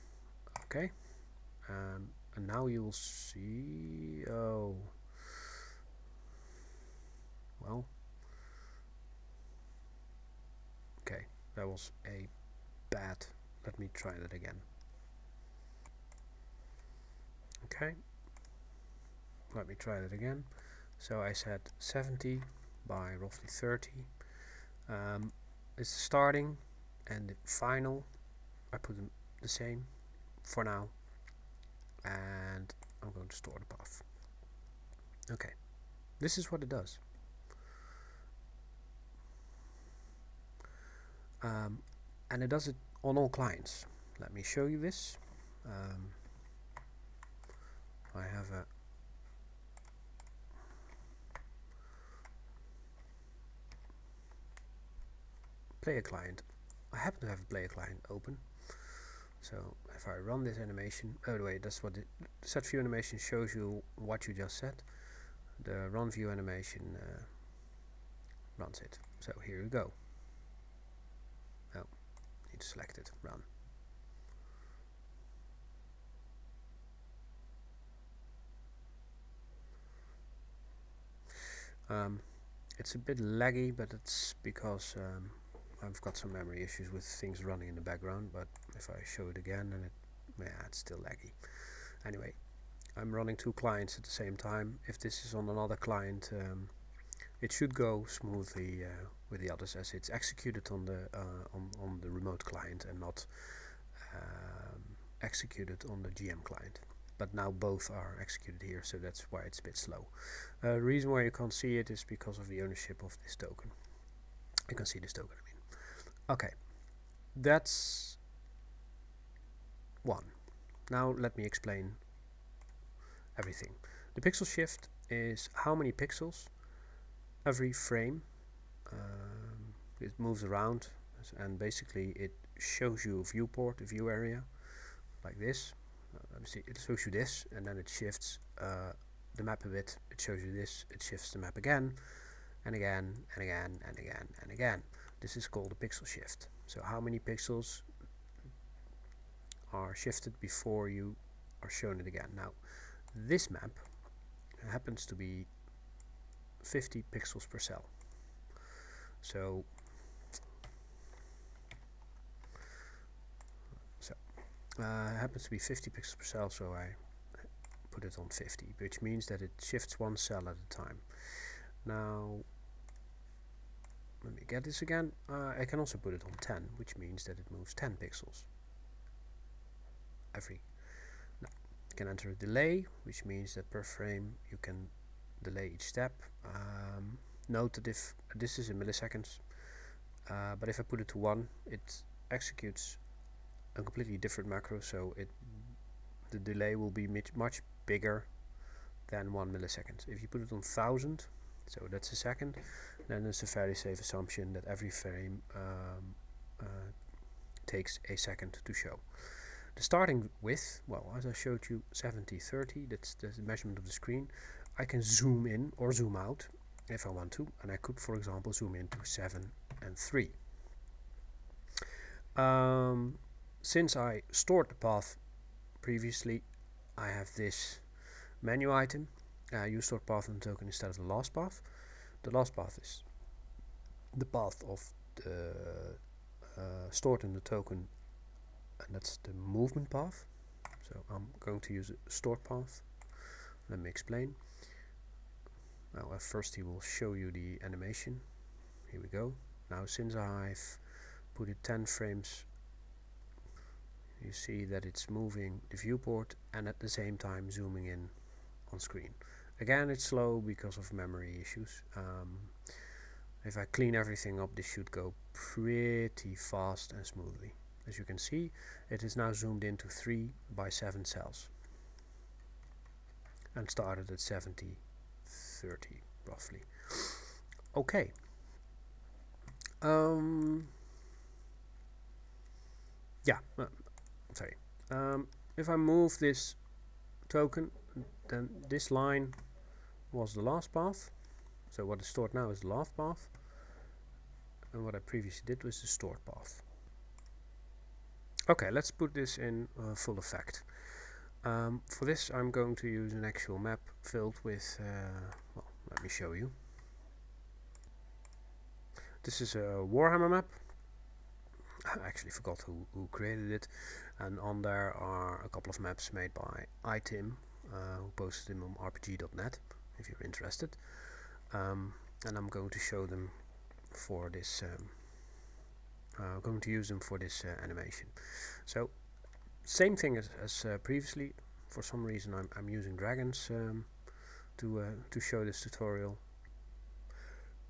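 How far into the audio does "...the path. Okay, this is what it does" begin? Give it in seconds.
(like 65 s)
33 s.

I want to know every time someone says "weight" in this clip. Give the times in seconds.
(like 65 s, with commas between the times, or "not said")
not said.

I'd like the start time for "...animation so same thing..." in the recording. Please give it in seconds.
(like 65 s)
327 s.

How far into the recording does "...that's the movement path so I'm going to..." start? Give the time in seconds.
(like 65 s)
238 s.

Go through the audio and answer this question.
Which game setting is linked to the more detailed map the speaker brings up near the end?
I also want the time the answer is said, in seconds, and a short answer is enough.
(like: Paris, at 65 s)
Warhammer, at 309 s.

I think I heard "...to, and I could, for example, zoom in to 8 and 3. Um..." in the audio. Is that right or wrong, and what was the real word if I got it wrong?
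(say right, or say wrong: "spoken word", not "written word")
wrong: "7", not "8".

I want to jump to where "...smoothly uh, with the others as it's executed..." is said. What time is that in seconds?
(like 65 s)
98 s.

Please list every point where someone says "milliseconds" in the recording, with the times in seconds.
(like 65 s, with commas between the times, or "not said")
188 s, 199 s.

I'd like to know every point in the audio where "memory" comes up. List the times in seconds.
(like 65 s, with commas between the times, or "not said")
86 s, 260 s.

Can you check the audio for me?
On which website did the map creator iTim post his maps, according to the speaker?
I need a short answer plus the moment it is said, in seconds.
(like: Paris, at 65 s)
rpg.net, at 318 s.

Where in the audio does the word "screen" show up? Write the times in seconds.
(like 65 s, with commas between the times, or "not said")
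213 s, 258 s.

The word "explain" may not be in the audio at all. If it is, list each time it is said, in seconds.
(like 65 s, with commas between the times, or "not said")
121 s, 243 s.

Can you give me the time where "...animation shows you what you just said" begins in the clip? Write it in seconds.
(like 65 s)
62 s.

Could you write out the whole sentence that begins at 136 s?
Uh, it shows you this and then it shifts uh, the map a bit.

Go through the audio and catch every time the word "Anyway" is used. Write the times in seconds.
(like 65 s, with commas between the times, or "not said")
92 s.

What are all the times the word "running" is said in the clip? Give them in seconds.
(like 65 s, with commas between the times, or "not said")
87 s, 93 s.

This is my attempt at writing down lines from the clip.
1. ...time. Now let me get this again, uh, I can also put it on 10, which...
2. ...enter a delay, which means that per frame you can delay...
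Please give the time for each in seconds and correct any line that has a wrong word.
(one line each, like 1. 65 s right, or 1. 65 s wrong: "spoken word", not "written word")
1. 170 s right
2. 182 s right.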